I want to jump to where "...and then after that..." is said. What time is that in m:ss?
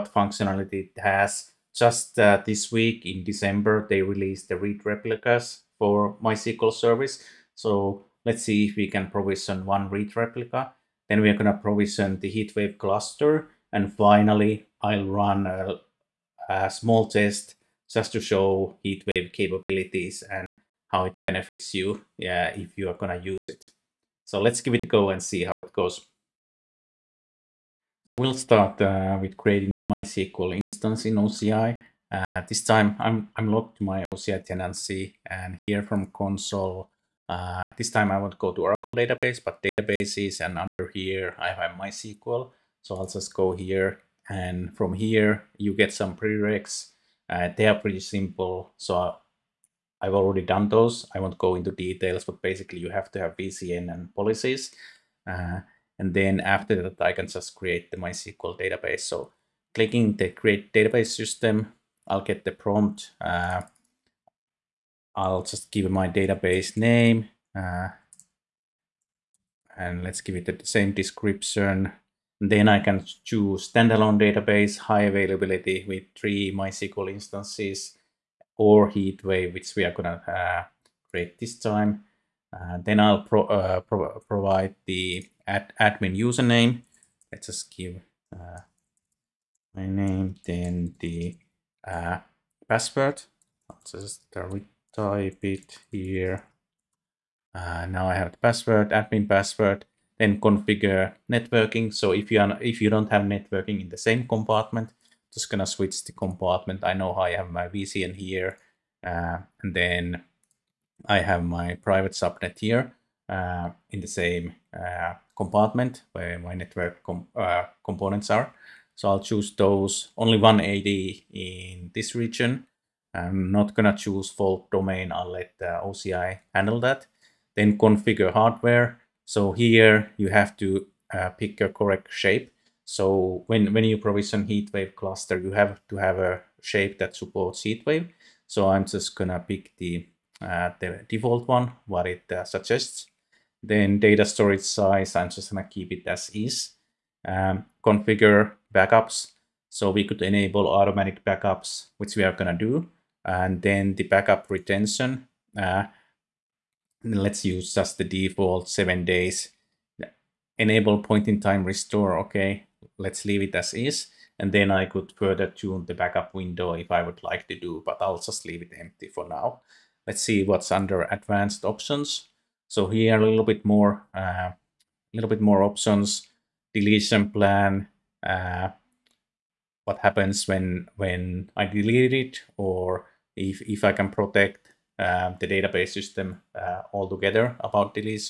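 0:55.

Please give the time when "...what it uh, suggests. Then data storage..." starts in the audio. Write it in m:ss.
2:21.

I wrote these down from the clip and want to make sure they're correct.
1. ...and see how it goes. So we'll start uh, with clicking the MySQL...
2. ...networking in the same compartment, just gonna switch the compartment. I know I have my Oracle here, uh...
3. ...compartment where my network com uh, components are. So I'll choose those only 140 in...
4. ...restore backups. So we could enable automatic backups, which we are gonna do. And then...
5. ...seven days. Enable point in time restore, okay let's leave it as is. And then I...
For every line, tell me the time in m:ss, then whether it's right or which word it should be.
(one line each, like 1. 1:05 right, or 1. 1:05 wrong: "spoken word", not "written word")
1. 0:25 wrong: "creating", not "clicking"
2. 1:43 wrong: "VCN", not "Oracle"
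3. 1:55 wrong: "180", not "140"
4. 2:27 wrong: "configure", not "restore"
5. 2:38 right.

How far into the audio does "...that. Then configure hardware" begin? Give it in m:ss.
2:06.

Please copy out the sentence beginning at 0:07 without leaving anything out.
So let's see if we can provision one read replica.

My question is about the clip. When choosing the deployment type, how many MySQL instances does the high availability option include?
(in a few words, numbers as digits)
3.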